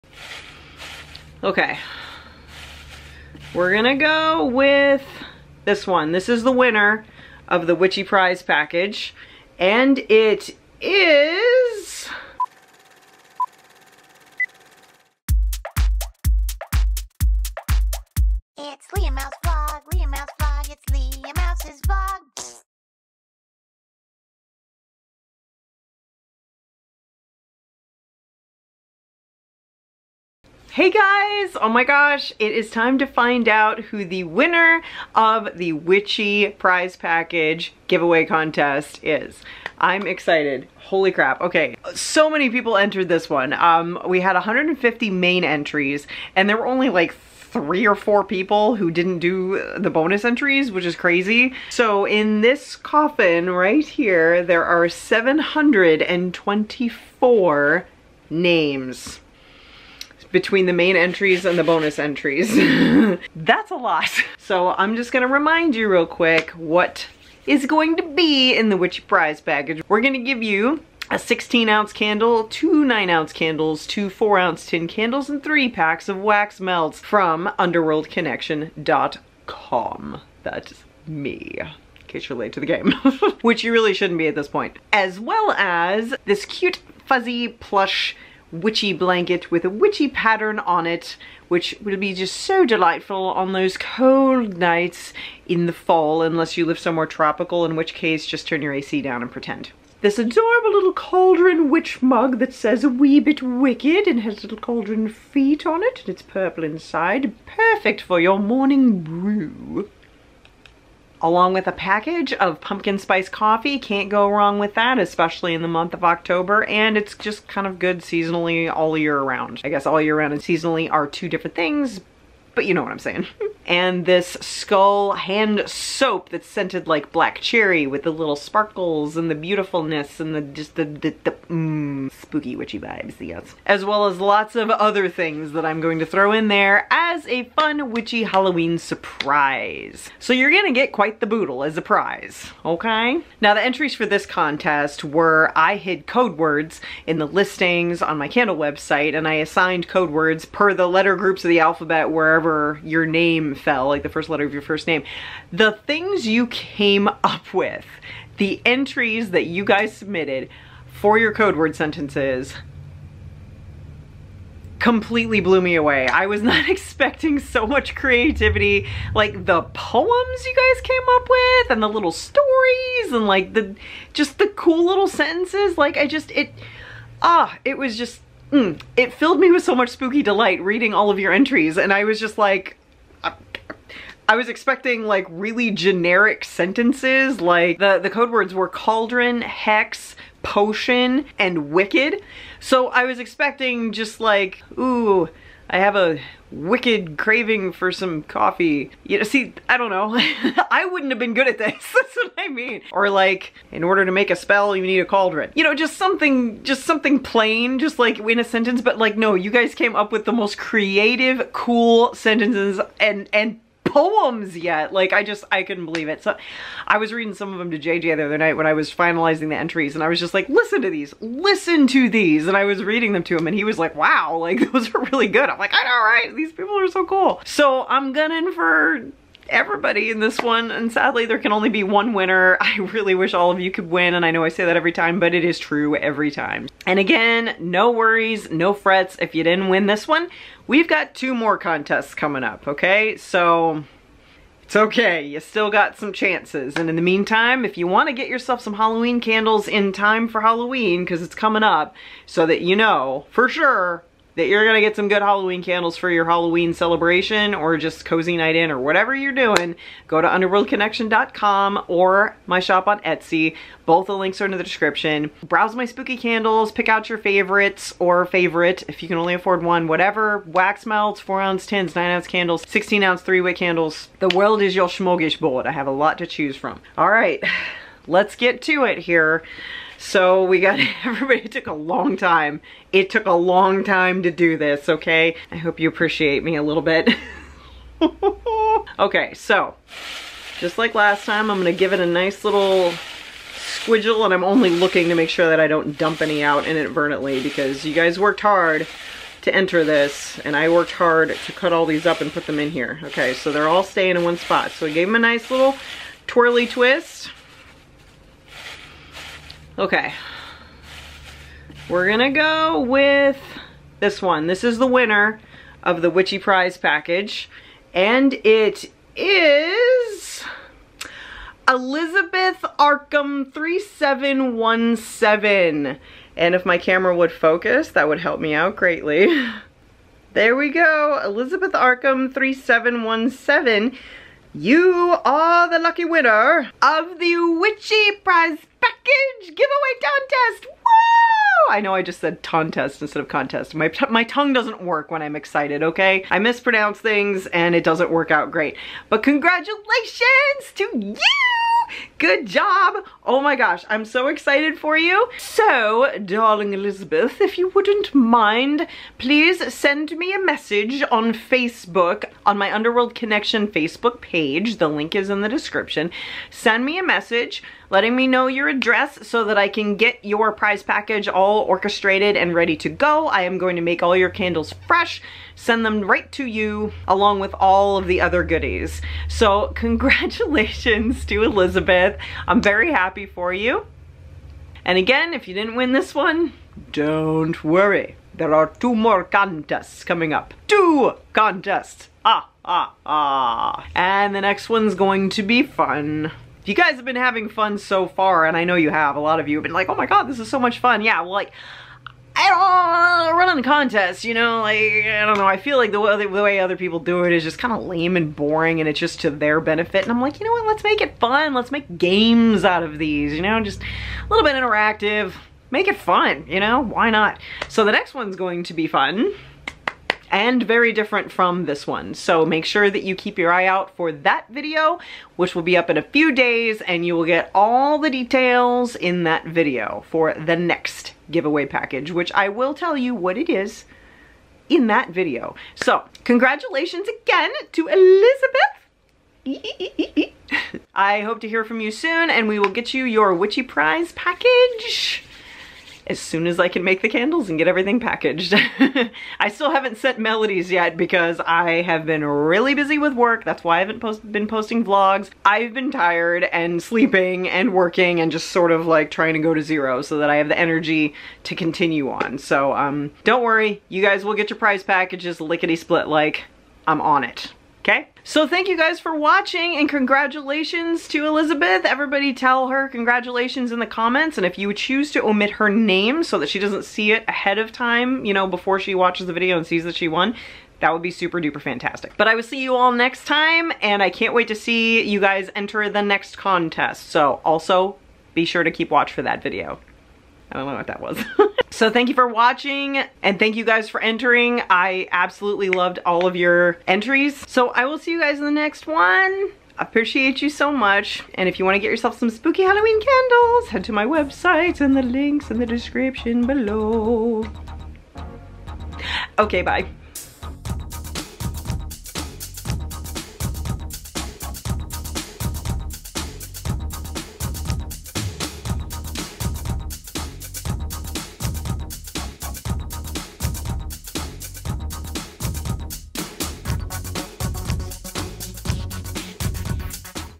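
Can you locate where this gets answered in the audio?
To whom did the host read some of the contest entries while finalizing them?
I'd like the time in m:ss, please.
3:37.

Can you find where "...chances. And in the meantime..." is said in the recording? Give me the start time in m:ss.
4:06.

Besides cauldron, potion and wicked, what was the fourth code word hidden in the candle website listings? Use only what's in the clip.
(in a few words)
Hex.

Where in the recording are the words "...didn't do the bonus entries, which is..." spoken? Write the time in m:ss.
0:48.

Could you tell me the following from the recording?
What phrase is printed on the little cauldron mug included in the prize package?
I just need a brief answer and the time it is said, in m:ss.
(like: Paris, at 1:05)
A wee bit wicked, at 1:42.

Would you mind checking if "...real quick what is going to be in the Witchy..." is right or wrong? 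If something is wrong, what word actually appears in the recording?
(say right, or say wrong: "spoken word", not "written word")
right.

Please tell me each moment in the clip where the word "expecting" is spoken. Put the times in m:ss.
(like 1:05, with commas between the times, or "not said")
2:46, 3:04, 3:13.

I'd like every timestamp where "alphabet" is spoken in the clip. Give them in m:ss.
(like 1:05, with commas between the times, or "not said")
2:31.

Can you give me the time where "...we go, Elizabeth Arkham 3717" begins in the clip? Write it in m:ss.
5:30.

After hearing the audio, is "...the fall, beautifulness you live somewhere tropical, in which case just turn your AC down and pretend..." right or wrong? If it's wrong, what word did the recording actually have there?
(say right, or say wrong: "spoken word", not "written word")
wrong: "unless", not "beautifulness".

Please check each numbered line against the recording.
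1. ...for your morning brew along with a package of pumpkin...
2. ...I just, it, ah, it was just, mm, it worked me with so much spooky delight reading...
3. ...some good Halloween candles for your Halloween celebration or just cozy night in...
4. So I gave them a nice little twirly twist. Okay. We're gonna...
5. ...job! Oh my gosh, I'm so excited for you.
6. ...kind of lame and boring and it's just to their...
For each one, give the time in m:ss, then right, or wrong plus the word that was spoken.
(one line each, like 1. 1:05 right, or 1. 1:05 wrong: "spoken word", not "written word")
1. 1:48 right
2. 2:55 wrong: "filled", not "worked"
3. 4:14 right
4. 5:04 right
5. 5:52 right
6. 6:47 right.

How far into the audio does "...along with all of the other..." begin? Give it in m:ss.
6:17.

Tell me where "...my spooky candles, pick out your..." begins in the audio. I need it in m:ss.
4:25.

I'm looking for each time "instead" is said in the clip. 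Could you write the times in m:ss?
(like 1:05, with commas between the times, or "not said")
5:43.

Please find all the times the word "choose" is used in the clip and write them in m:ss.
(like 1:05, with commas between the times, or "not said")
4:36, 7:54.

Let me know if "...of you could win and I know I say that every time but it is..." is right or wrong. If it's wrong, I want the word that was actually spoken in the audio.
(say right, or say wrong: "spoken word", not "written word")
right.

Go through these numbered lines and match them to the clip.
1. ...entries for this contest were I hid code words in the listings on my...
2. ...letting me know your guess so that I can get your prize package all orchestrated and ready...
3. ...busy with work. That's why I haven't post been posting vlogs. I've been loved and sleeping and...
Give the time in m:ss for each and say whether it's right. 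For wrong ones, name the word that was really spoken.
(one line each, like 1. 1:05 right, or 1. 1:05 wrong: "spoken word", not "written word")
1. 2:23 right
2. 6:07 wrong: "address", not "guess"
3. 7:32 wrong: "tired", not "loved".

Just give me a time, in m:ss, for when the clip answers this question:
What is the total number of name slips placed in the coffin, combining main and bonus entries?
0:54.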